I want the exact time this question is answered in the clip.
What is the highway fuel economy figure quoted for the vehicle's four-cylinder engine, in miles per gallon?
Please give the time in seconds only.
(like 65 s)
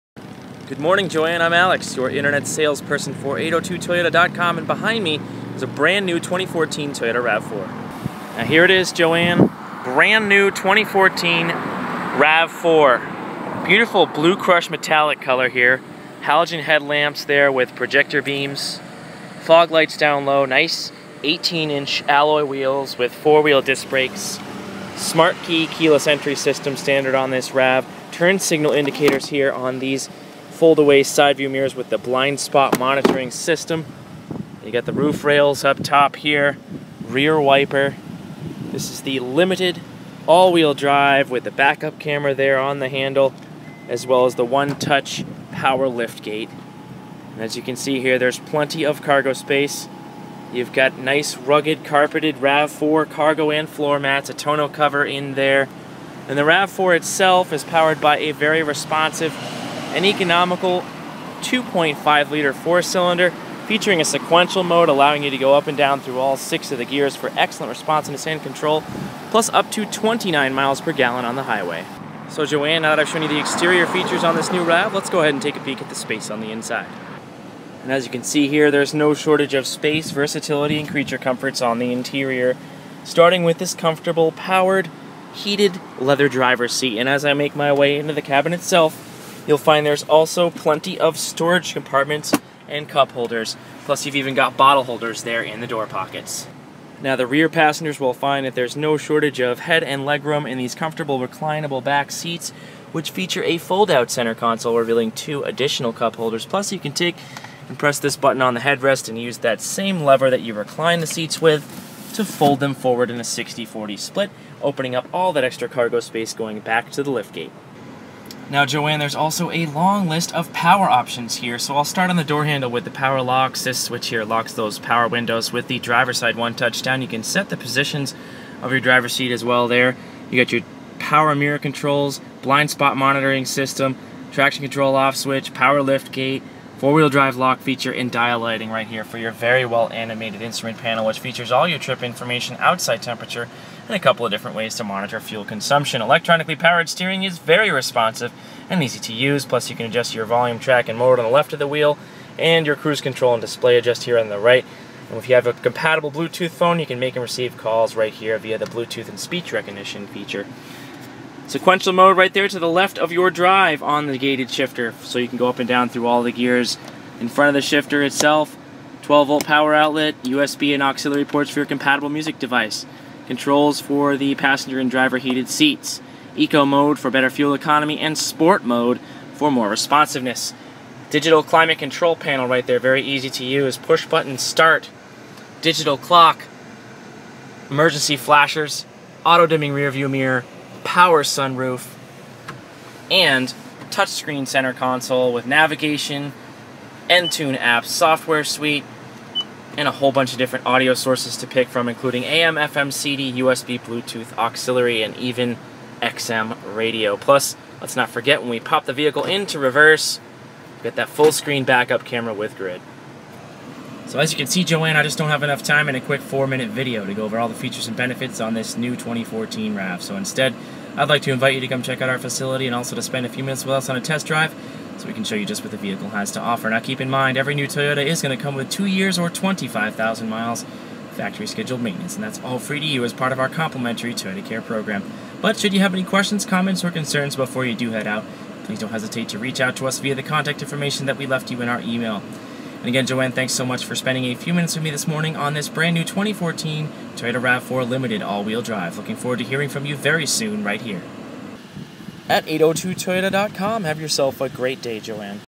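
69 s.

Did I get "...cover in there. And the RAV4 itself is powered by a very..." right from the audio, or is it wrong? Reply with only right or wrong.
right.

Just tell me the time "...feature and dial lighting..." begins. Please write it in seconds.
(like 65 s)
137 s.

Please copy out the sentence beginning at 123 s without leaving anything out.
This switch here locks those power windows with the driver's side one touchdown.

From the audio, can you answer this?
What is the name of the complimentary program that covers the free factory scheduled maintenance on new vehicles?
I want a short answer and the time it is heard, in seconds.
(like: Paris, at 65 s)
Toyota Care, at 234 s.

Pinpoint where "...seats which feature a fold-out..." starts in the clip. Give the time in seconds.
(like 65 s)
102 s.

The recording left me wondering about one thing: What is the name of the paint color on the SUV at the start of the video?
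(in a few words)
Blue crush metallic.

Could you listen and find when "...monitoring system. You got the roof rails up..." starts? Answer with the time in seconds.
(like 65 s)
32 s.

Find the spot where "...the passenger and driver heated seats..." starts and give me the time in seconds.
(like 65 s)
174 s.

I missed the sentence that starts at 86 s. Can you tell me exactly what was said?
And as I make my way into the cabin itself, You'll find there's also plenty of storage compartments and cup holders.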